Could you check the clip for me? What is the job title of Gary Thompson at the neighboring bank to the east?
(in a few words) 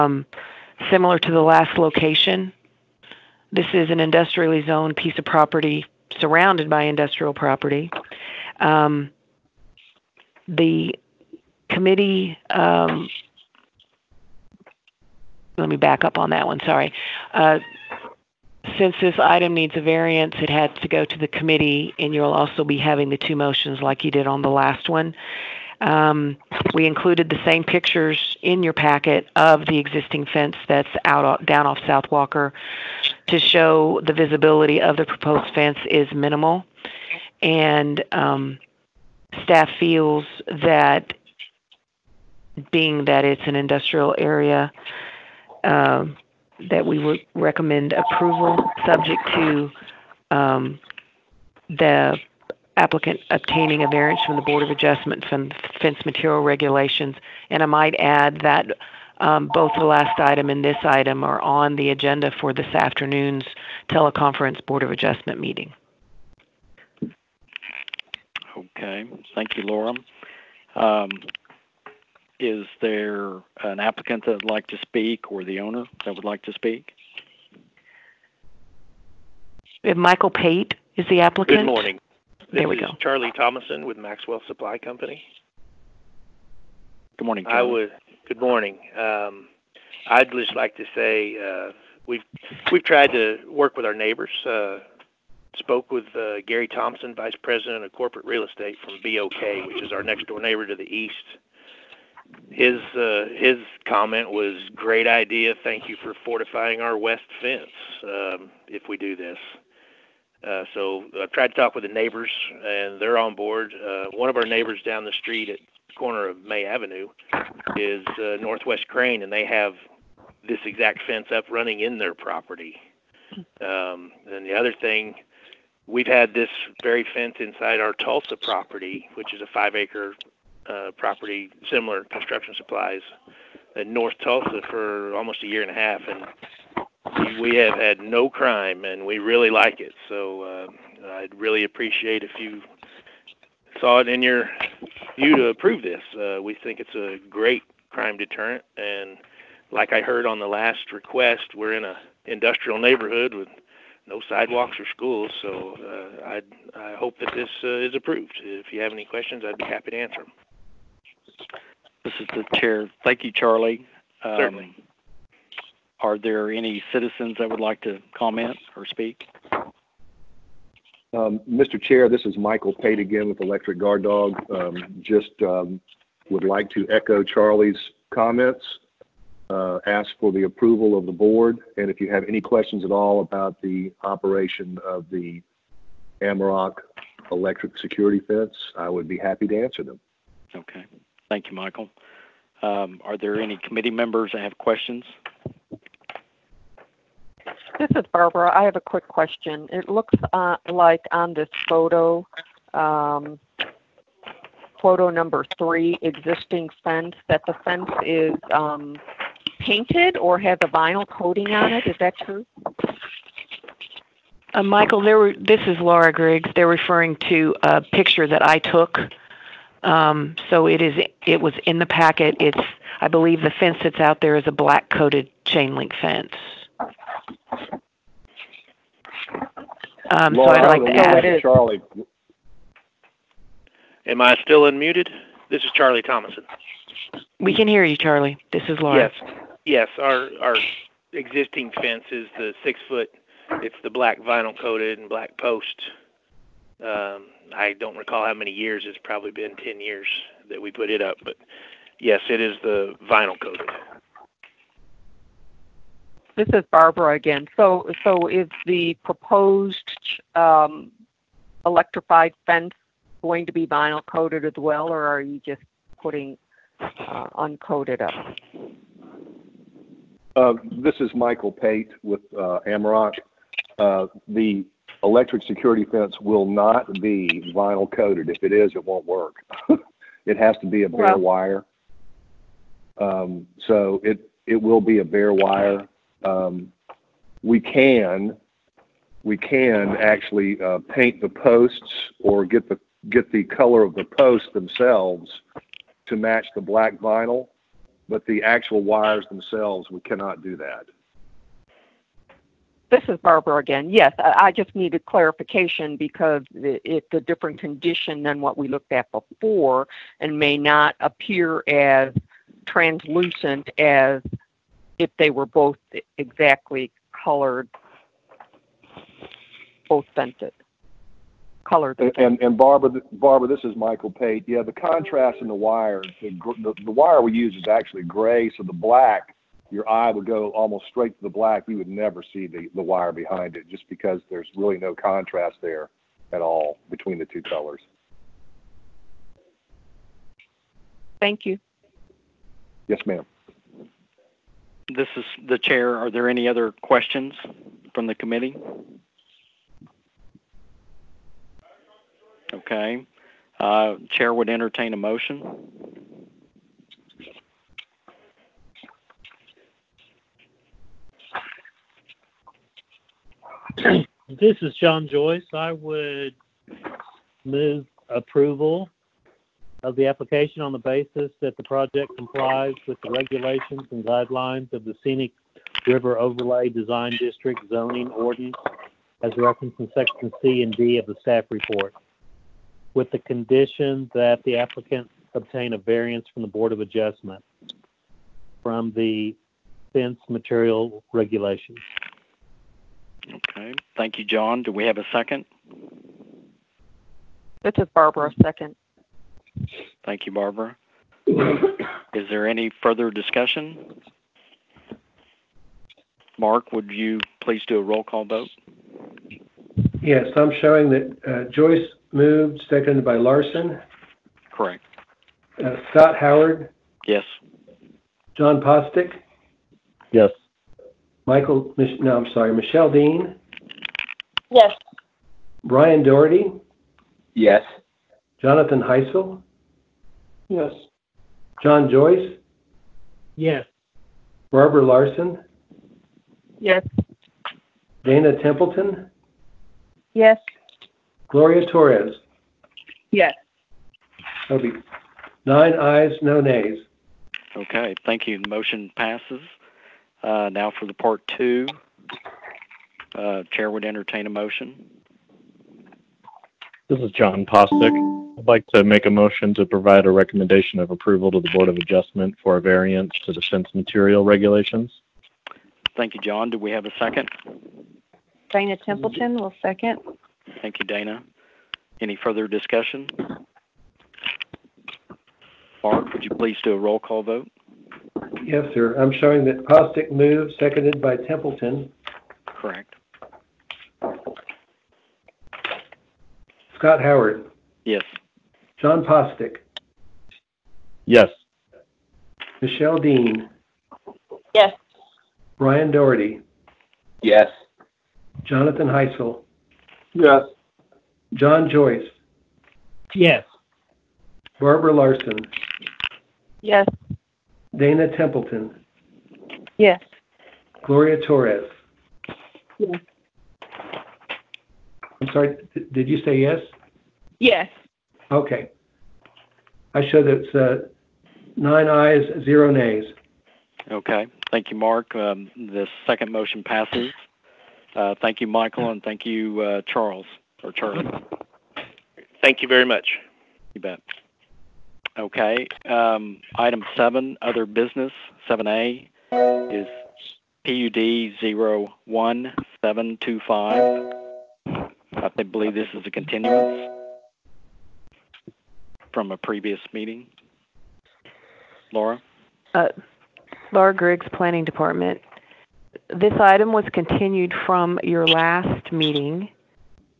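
Vice President of Corporate Real Estate.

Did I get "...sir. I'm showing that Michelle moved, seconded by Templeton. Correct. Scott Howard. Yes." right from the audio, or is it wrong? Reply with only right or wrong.
wrong.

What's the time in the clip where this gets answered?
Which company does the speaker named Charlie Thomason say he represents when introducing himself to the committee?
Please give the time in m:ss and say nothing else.
1:23.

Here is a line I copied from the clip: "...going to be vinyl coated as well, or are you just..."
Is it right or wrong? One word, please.
right.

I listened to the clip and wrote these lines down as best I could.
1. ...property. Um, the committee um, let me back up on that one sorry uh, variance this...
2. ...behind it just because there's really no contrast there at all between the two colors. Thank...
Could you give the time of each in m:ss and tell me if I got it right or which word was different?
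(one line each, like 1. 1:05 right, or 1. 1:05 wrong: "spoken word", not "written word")
1. 0:07 wrong: "since", not "variance"
2. 5:33 right.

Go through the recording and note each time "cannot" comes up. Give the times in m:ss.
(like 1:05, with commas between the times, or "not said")
5:00.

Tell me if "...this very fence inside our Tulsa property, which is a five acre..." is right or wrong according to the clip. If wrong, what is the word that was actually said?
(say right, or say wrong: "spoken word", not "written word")
right.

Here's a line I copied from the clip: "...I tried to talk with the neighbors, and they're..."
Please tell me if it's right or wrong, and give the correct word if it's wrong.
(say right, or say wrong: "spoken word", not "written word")
right.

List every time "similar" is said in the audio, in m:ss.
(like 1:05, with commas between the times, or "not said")
0:00, 2:11.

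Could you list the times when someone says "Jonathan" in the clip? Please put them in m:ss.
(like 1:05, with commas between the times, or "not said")
7:08, 8:18.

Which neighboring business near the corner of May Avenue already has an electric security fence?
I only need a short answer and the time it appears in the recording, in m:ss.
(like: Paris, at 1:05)
Northwest Crane, at 1:58.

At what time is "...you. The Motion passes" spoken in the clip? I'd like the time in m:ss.
7:28.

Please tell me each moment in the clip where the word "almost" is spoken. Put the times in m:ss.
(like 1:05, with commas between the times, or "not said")
2:15, 5:30.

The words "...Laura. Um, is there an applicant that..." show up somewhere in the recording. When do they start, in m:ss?
1:09.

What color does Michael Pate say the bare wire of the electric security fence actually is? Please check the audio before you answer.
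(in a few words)
gray.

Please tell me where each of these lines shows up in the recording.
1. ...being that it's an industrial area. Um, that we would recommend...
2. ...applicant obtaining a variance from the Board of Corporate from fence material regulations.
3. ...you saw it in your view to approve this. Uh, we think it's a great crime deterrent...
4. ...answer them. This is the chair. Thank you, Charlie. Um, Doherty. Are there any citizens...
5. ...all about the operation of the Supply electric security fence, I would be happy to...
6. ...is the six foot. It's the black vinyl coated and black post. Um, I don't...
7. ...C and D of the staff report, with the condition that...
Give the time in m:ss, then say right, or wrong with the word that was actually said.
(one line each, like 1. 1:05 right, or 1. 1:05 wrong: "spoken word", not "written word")
1. 0:42 right
2. 0:52 wrong: "Adjustment", not "Corporate"
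3. 2:22 right
4. 2:39 wrong: "Certainly", not "Doherty"
5. 3:02 wrong: "Amarok", not "Supply"
6. 4:02 right
7. 6:20 right.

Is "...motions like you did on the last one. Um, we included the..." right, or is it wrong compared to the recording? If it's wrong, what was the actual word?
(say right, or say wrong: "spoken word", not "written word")
right.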